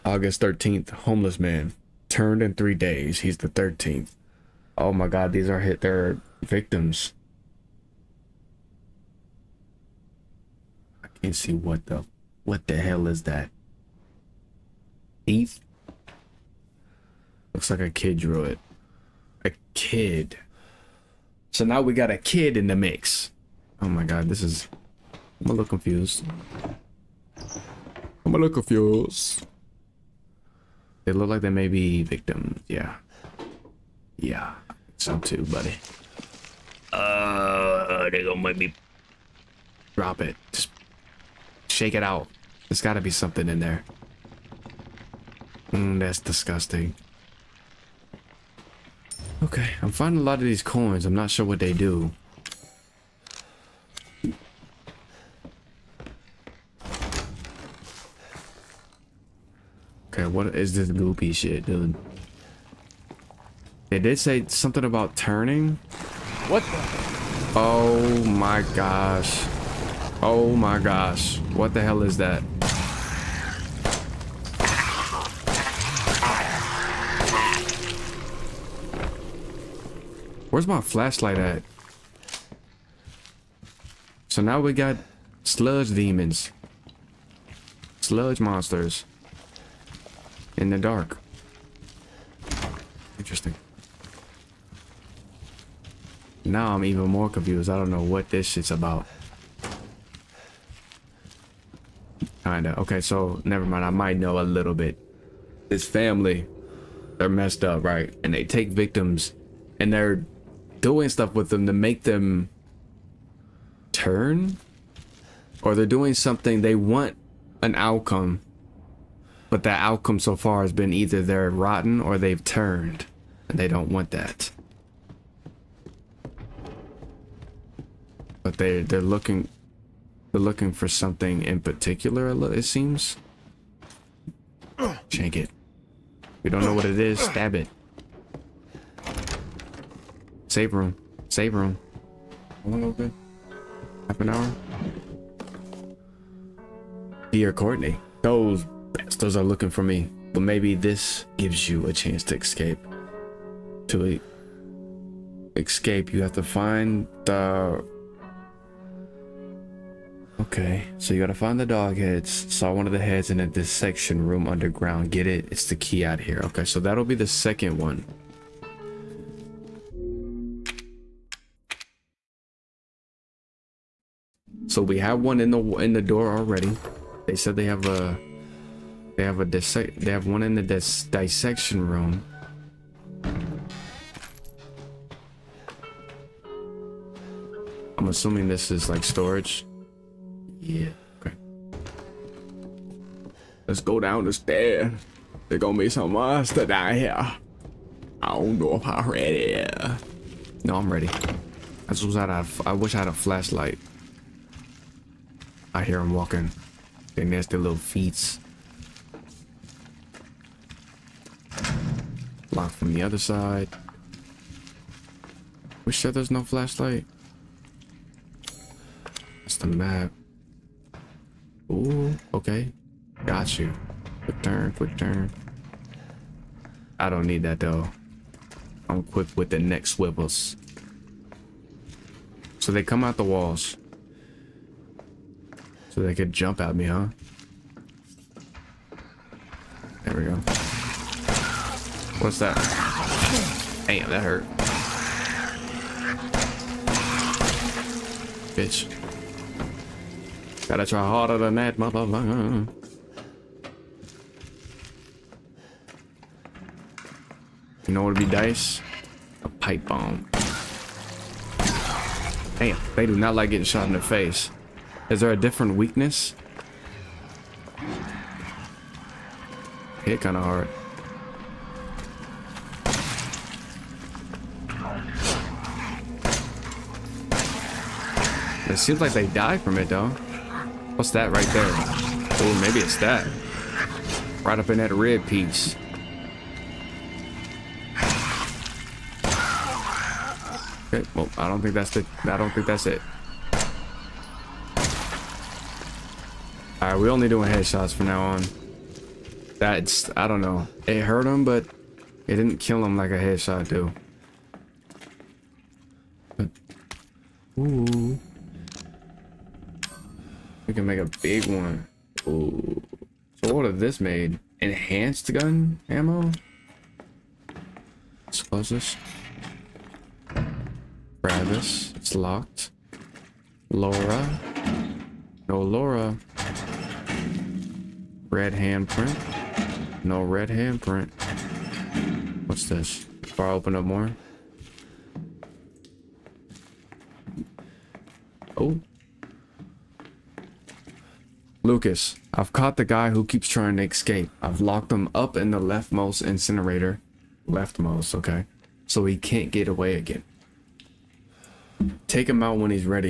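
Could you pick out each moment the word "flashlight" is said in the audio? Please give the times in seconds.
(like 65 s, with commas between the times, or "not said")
80 s, 203 s, 216 s.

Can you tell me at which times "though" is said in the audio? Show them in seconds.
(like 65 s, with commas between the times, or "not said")
227 s, 279 s.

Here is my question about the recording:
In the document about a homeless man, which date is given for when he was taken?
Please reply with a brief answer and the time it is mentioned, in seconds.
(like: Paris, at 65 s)
August 13th, at 0 s.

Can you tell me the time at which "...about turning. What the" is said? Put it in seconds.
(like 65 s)
64 s.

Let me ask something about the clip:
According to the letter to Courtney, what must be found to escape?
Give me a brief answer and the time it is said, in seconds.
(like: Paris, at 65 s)
The dog heads, at 161 s.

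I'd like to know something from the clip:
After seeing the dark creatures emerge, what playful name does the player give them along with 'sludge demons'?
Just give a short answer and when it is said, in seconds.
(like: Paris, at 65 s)
Sludge monsters, at 88 s.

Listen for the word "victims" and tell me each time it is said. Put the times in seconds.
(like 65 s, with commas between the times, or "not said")
6 s, 32 s, 108 s.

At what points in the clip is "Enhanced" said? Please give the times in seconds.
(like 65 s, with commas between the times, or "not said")
314 s.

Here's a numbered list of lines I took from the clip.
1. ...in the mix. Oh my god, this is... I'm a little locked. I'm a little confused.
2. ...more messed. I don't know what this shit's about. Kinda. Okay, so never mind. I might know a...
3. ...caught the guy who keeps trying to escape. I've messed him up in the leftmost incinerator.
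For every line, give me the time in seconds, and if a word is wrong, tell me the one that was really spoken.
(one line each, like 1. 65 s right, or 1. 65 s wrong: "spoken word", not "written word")
1. 22 s wrong: "confused", not "locked"
2. 97 s wrong: "confused", not "messed"
3. 342 s wrong: "locked", not "messed".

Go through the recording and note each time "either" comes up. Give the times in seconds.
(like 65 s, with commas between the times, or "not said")
120 s.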